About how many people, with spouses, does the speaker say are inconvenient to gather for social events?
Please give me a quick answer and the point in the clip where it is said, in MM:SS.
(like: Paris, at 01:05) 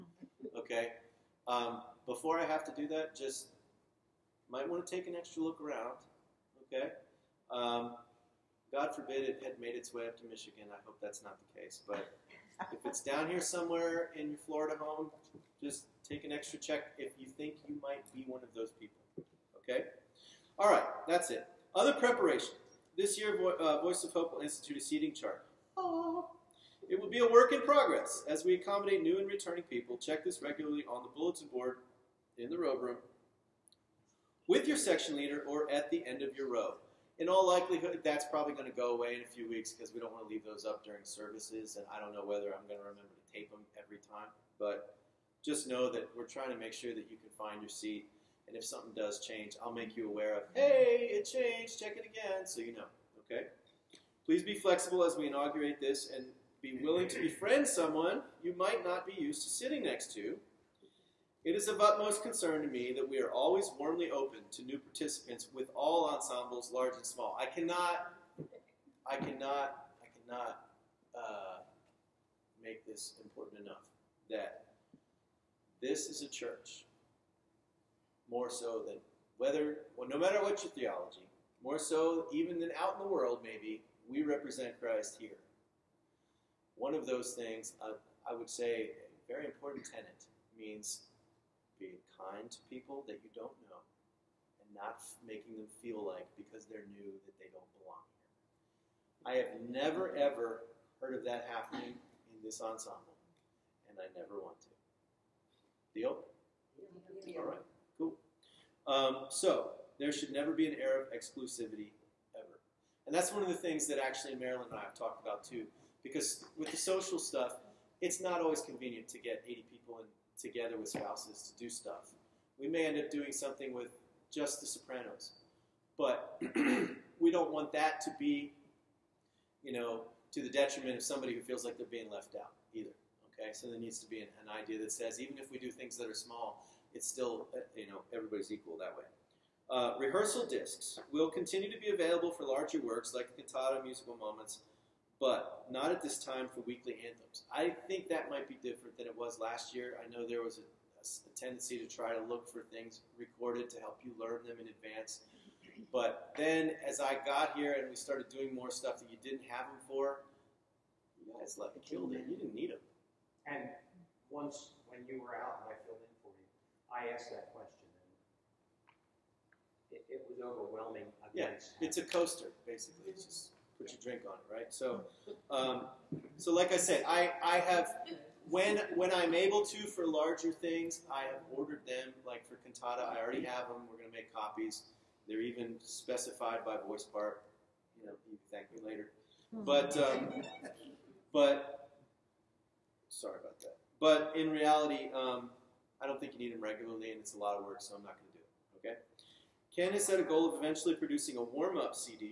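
80, at 01:59.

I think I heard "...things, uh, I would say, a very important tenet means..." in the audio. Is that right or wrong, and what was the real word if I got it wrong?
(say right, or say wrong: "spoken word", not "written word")
right.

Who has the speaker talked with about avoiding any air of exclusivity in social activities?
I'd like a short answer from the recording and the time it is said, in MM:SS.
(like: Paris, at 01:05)
Marilyn, at 01:54.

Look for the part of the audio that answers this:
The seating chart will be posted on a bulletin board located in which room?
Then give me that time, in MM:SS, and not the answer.
00:32.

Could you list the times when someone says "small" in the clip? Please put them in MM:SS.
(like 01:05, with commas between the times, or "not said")
01:07, 02:16.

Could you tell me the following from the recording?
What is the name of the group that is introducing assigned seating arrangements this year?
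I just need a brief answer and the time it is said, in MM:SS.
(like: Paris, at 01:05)
Voice of Hope, at 00:23.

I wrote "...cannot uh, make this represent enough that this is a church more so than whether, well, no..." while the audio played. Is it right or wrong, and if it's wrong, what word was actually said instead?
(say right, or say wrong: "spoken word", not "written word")
wrong: "important", not "represent".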